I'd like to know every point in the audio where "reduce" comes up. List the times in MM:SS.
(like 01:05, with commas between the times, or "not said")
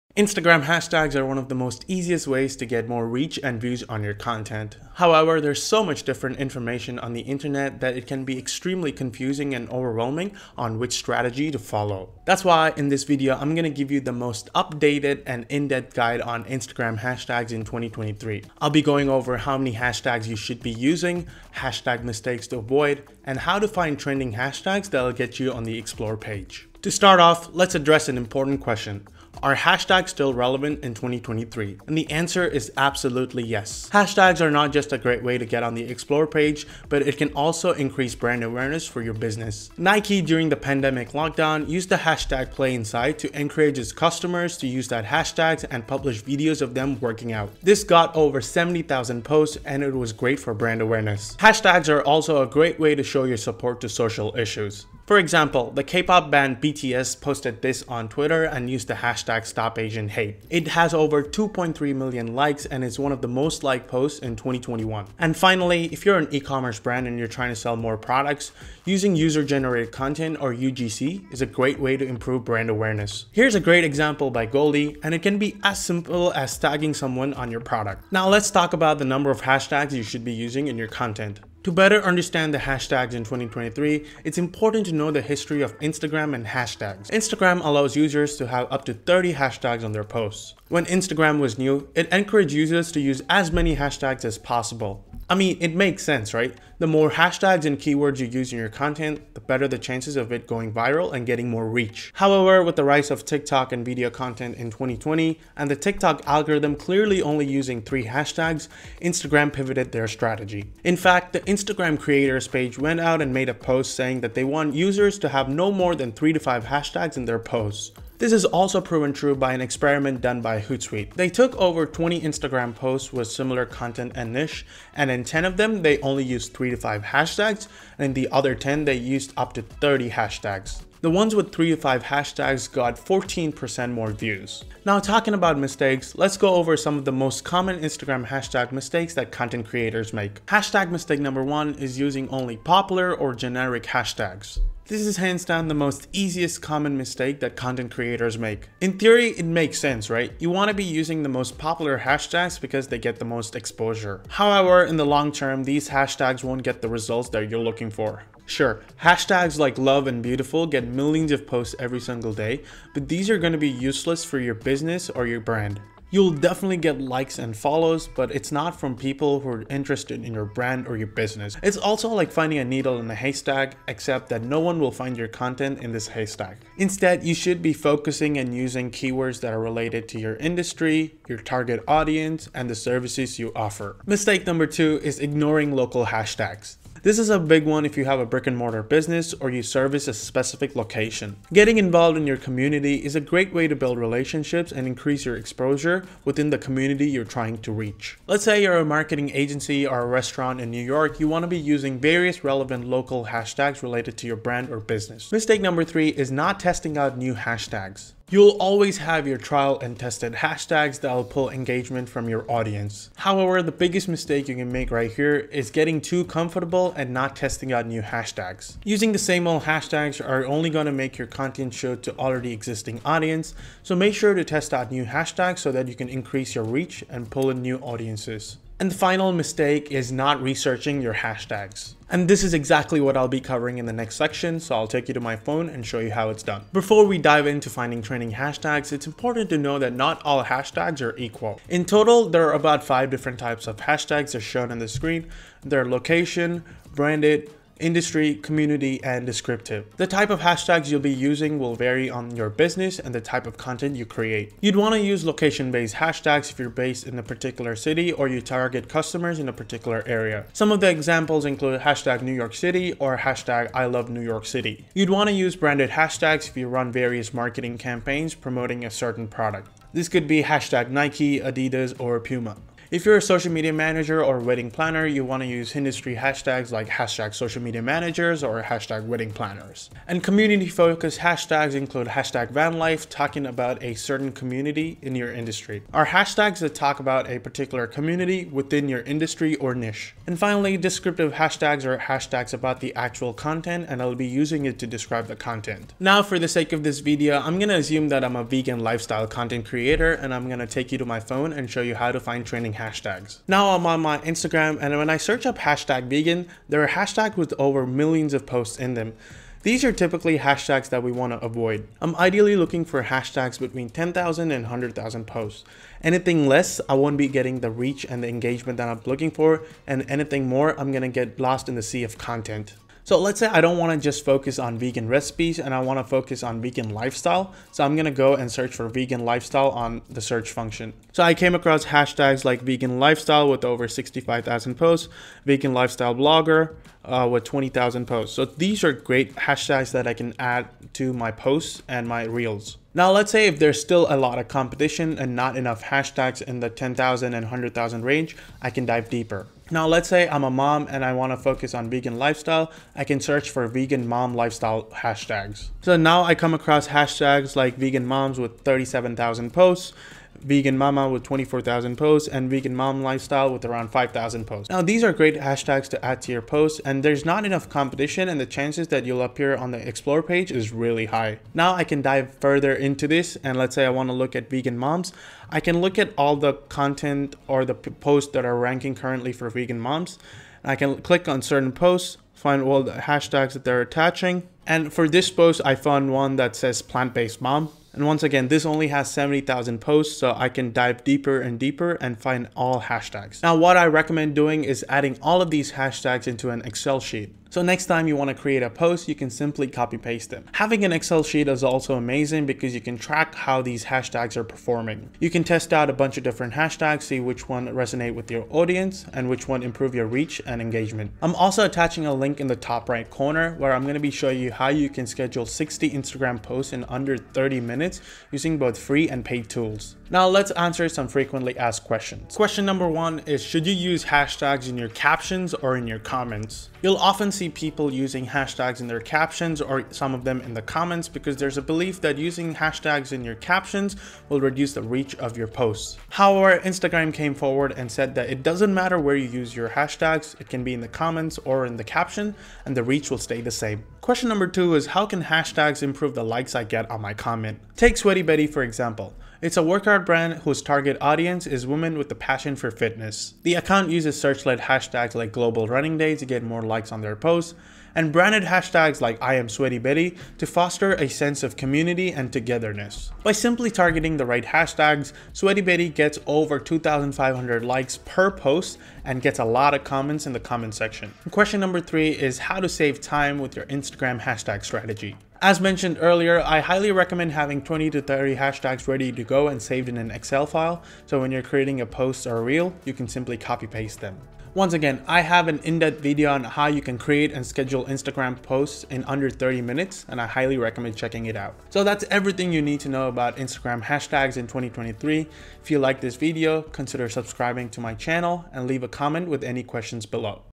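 07:14.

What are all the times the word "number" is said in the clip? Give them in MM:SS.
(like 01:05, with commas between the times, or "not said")
01:19, 02:21, 03:04, 03:25, 07:02, 07:24, 07:51.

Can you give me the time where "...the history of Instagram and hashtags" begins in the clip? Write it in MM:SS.
01:25.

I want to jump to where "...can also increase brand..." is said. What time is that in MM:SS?
00:37.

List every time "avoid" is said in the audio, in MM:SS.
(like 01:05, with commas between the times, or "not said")
00:22, 05:11.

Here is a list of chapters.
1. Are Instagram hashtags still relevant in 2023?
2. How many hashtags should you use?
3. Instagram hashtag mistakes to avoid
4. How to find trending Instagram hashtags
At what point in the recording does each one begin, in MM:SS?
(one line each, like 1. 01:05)
1. 00:30
2. 01:20
3. 02:17
4. 04:00.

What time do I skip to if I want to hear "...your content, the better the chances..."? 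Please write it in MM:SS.
01:38.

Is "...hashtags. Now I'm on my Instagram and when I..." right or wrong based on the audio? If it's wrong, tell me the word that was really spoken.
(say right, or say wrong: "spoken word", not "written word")
right.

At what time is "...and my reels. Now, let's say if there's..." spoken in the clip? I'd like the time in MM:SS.
05:41.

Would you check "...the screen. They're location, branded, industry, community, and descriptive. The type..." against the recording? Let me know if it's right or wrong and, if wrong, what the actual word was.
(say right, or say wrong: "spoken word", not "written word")
right.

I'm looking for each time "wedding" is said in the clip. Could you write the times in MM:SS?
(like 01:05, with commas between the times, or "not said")
04:34, 04:39.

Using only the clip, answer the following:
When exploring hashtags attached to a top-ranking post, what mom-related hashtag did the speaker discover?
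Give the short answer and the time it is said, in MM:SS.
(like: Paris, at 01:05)
plant-based mom, at 06:26.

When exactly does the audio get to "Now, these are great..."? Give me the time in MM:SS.
06:04.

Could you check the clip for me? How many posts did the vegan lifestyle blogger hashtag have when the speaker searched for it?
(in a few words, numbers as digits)
20,000.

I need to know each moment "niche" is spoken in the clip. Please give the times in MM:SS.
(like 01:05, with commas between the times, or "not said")
02:04, 04:49.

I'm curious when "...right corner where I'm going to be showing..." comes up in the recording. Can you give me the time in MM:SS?
06:52.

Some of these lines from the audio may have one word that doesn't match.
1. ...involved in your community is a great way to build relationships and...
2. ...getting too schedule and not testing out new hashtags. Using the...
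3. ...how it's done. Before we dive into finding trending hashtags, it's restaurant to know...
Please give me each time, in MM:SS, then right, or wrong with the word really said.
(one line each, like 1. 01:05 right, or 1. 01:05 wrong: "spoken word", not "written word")
1. 03:11 right
2. 03:35 wrong: "comfortable", not "schedule"
3. 03:56 wrong: "important", not "restaurant".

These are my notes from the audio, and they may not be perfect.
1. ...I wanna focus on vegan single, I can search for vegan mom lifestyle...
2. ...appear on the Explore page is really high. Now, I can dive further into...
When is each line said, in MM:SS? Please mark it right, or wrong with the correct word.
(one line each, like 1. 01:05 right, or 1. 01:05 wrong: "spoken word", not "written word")
1. 05:51 wrong: "lifestyle", not "single"
2. 06:09 right.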